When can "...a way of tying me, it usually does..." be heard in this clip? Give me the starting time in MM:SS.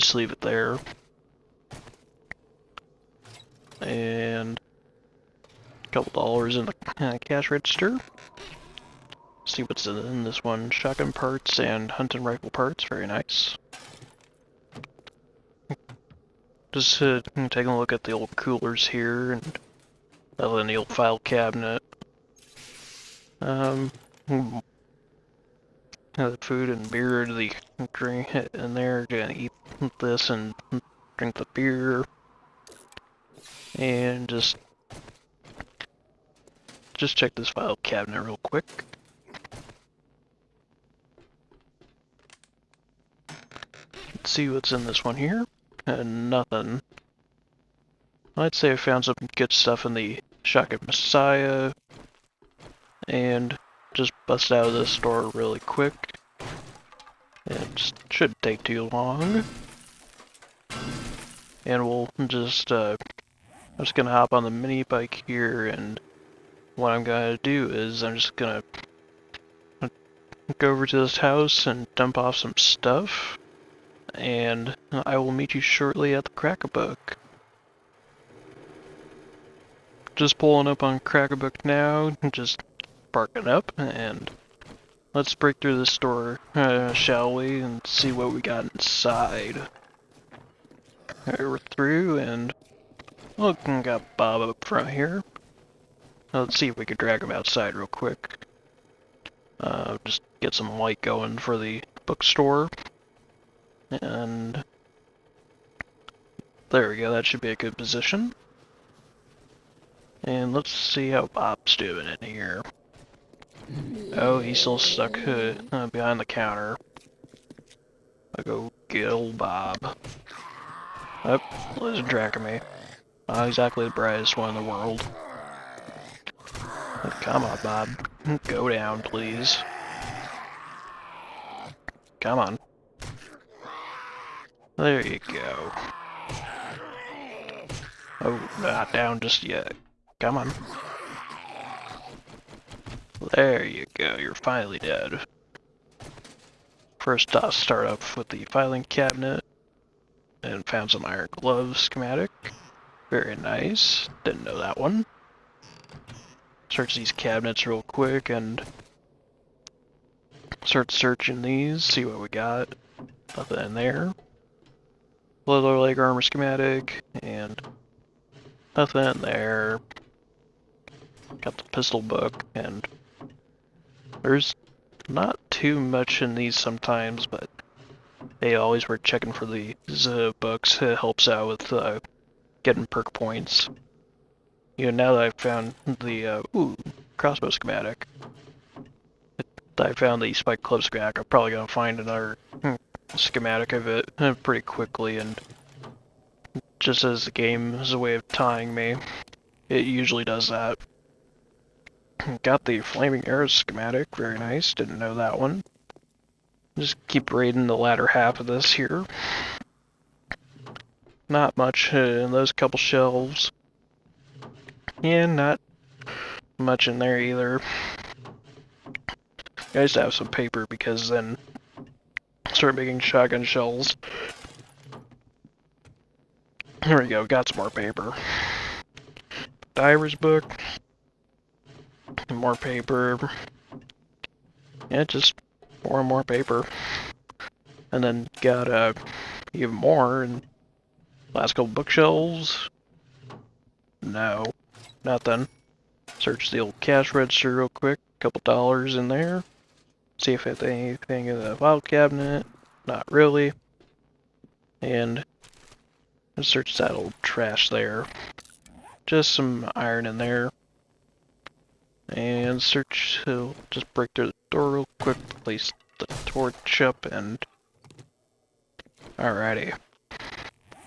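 03:17.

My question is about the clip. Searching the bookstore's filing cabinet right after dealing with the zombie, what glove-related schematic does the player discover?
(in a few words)
Iron glove schematic.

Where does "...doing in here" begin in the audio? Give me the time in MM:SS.
01:51.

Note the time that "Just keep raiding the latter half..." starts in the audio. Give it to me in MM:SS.
03:26.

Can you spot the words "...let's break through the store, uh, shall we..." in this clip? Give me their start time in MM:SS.
01:25.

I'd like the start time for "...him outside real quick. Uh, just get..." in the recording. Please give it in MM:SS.
01:37.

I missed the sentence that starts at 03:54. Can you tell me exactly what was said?
Yeah, just more and more paper.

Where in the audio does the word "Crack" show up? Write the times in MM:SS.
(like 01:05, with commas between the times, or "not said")
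01:16, 01:20.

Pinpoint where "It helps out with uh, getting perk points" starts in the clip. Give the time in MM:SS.
03:00.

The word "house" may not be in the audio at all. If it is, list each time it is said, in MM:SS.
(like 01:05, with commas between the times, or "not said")
01:11.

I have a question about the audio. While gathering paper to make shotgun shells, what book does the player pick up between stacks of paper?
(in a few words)
Diver's book.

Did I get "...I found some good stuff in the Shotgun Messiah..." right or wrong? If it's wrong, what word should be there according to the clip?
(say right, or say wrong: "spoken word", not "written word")
right.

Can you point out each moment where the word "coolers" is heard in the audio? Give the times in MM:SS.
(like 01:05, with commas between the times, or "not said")
00:18.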